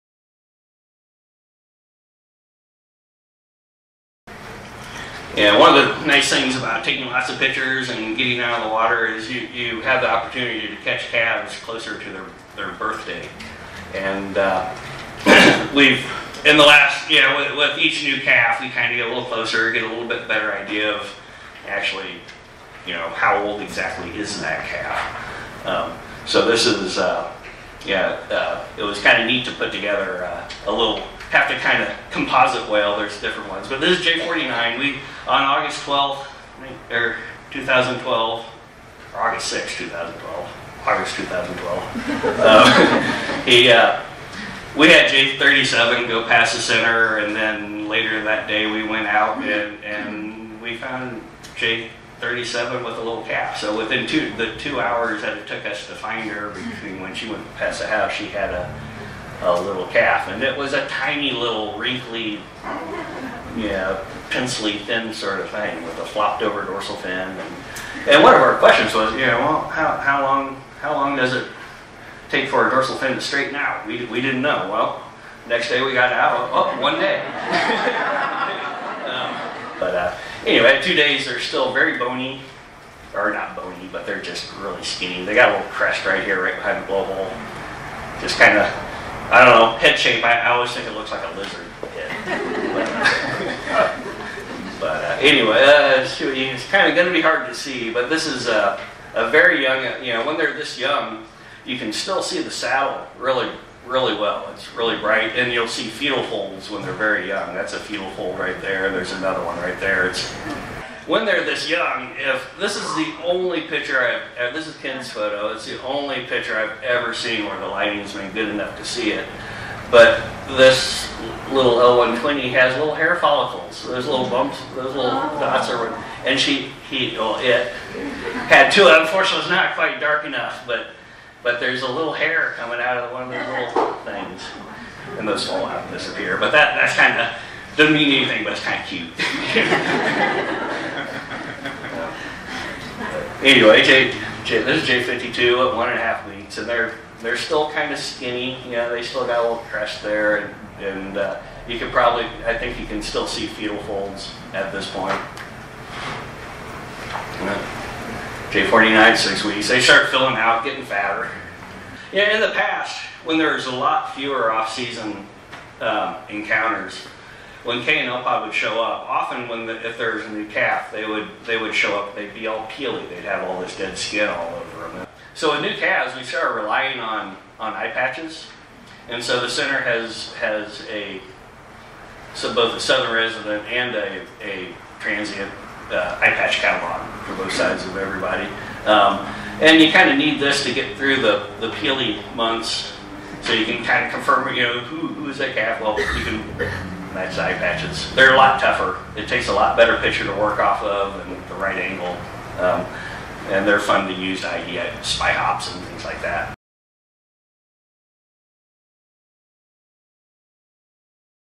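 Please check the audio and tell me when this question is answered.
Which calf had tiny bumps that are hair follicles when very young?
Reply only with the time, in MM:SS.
02:01.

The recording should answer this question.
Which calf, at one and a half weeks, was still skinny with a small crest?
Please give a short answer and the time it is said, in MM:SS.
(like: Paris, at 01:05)
J52, at 02:24.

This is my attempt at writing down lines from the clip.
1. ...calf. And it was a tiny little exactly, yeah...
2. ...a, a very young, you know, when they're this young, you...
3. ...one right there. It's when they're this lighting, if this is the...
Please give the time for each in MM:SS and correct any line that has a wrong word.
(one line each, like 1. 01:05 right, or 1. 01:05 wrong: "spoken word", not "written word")
1. 00:59 wrong: "wrinkly", not "exactly"
2. 01:38 right
3. 01:49 wrong: "young", not "lighting".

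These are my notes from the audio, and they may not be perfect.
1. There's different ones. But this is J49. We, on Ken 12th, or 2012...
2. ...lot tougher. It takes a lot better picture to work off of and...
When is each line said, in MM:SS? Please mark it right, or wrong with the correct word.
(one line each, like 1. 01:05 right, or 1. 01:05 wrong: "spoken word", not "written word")
1. 00:32 wrong: "August", not "Ken"
2. 03:18 right.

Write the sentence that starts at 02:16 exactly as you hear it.
But that that's kind of doesn't mean anything, but it's kind of cute.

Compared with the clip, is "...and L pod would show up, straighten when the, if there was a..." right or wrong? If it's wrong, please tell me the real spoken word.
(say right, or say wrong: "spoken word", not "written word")
wrong: "often", not "straighten".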